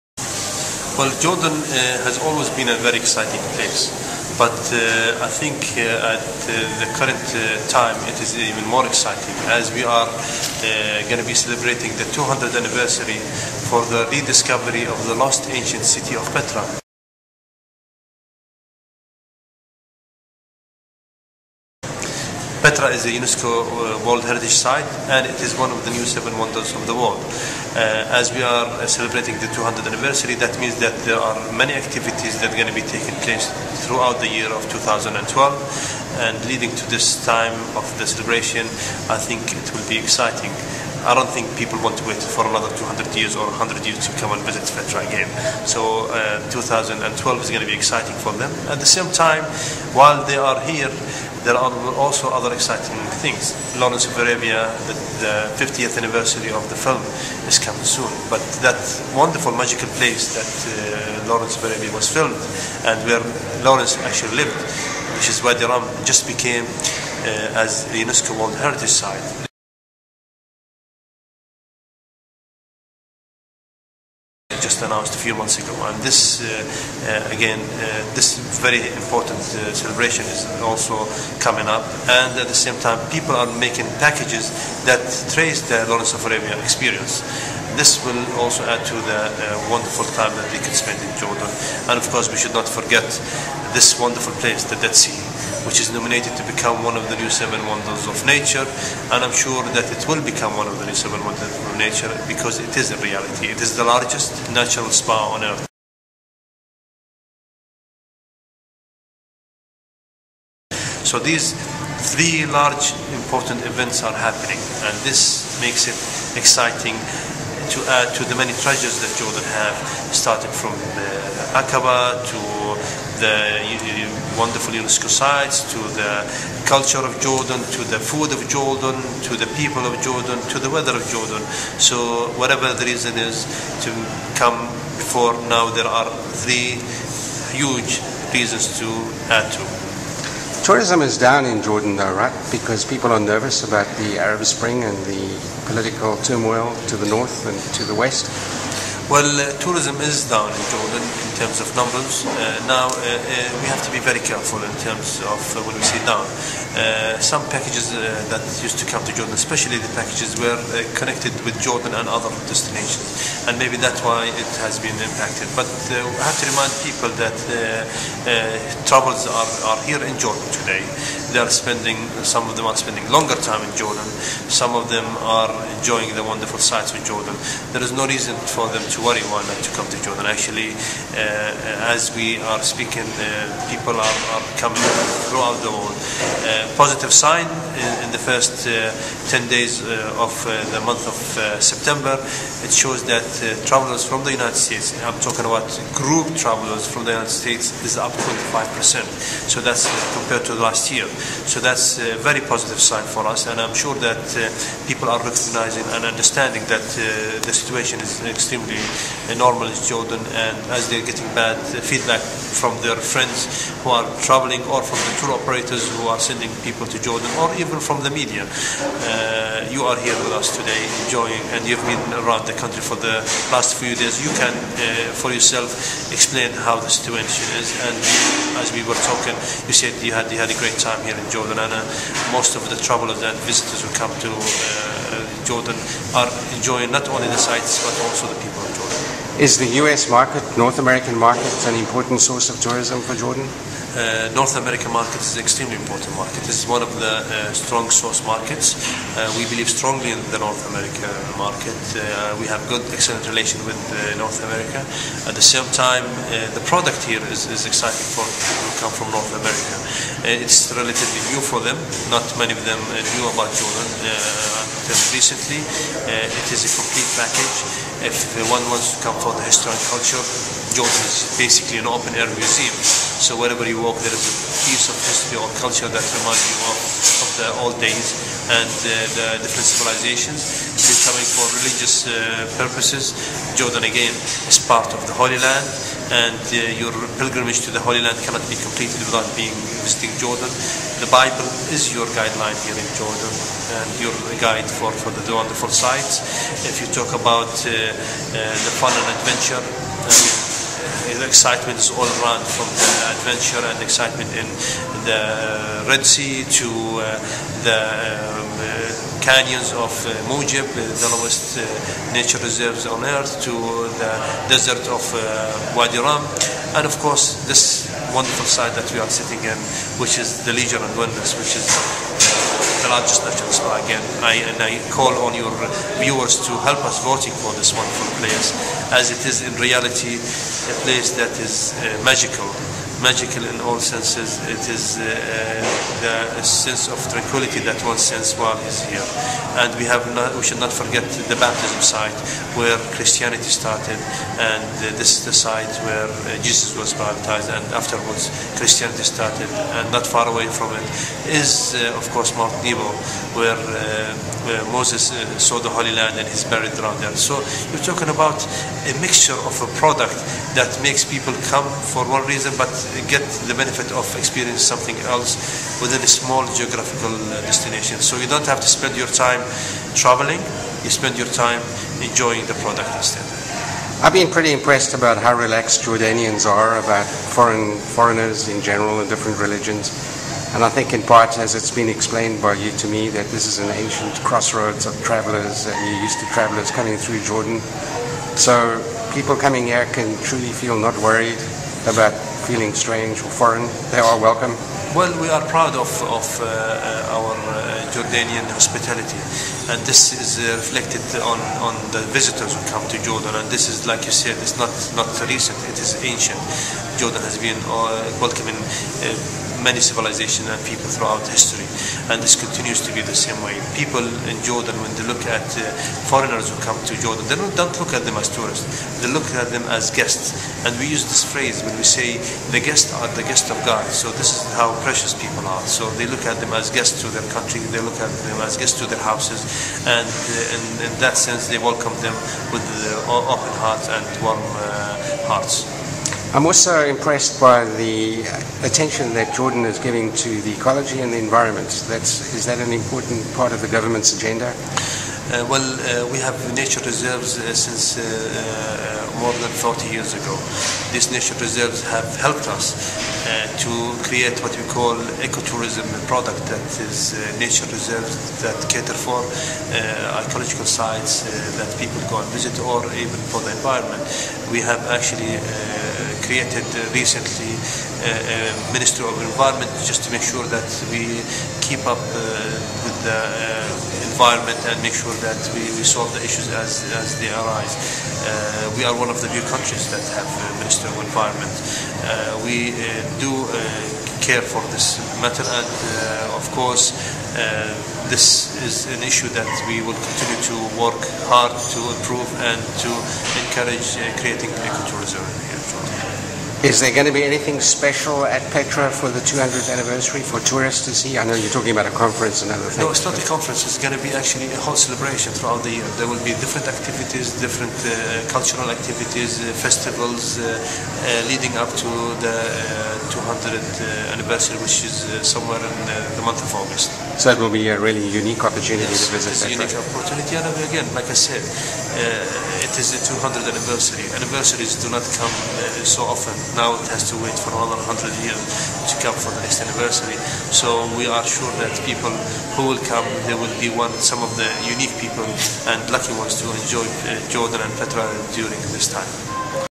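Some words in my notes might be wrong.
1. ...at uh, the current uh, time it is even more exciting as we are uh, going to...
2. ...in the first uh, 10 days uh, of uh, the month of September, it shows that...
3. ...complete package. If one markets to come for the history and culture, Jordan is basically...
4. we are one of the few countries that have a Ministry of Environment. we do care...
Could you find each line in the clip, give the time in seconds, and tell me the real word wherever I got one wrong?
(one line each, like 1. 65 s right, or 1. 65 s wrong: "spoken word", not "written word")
1. 6 s right
2. 188 s right
3. 266 s wrong: "wants", not "markets"
4. 478 s right.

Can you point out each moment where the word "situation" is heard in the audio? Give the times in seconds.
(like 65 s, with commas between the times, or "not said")
207 s, 226 s.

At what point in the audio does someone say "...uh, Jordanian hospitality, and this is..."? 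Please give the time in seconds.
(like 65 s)
397 s.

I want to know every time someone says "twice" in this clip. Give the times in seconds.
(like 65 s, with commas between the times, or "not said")
not said.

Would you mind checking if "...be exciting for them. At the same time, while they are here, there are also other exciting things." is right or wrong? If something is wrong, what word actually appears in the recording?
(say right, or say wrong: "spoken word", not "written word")
right.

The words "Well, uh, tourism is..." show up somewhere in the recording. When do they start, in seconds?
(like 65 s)
149 s.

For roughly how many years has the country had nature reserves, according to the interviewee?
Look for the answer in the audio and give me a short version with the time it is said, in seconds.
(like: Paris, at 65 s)
more than 40 years, at 449 s.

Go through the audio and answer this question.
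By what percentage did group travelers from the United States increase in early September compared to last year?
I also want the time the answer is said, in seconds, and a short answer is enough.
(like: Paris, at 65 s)
25%, at 197 s.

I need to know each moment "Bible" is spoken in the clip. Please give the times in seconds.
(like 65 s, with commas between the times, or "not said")
291 s.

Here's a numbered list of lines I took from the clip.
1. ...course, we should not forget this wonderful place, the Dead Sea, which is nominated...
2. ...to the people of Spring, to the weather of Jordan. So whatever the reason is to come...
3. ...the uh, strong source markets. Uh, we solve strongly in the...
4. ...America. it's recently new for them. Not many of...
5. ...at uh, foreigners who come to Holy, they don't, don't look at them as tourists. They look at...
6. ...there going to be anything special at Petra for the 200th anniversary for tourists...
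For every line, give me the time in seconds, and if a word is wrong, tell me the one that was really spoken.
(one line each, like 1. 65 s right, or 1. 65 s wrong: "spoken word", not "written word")
1. 92 s right
2. 129 s wrong: "Jordan", not "Spring"
3. 246 s wrong: "believe", not "solve"
4. 259 s wrong: "relatively", not "recently"
5. 415 s wrong: "Jordan", not "Holy"
6. 496 s right.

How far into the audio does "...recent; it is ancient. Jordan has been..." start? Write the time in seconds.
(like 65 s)
405 s.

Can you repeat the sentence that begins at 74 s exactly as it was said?
just announced a few months ago.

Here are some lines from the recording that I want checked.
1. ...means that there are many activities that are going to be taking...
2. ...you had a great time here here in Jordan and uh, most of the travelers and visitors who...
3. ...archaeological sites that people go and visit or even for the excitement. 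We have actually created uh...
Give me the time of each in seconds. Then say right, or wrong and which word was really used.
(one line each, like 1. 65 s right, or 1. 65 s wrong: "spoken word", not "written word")
1. 30 s right
2. 230 s right
3. 460 s wrong: "environment", not "excitement".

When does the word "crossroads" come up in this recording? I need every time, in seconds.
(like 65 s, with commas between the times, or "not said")
384 s.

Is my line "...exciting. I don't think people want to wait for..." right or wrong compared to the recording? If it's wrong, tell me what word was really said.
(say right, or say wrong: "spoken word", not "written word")
right.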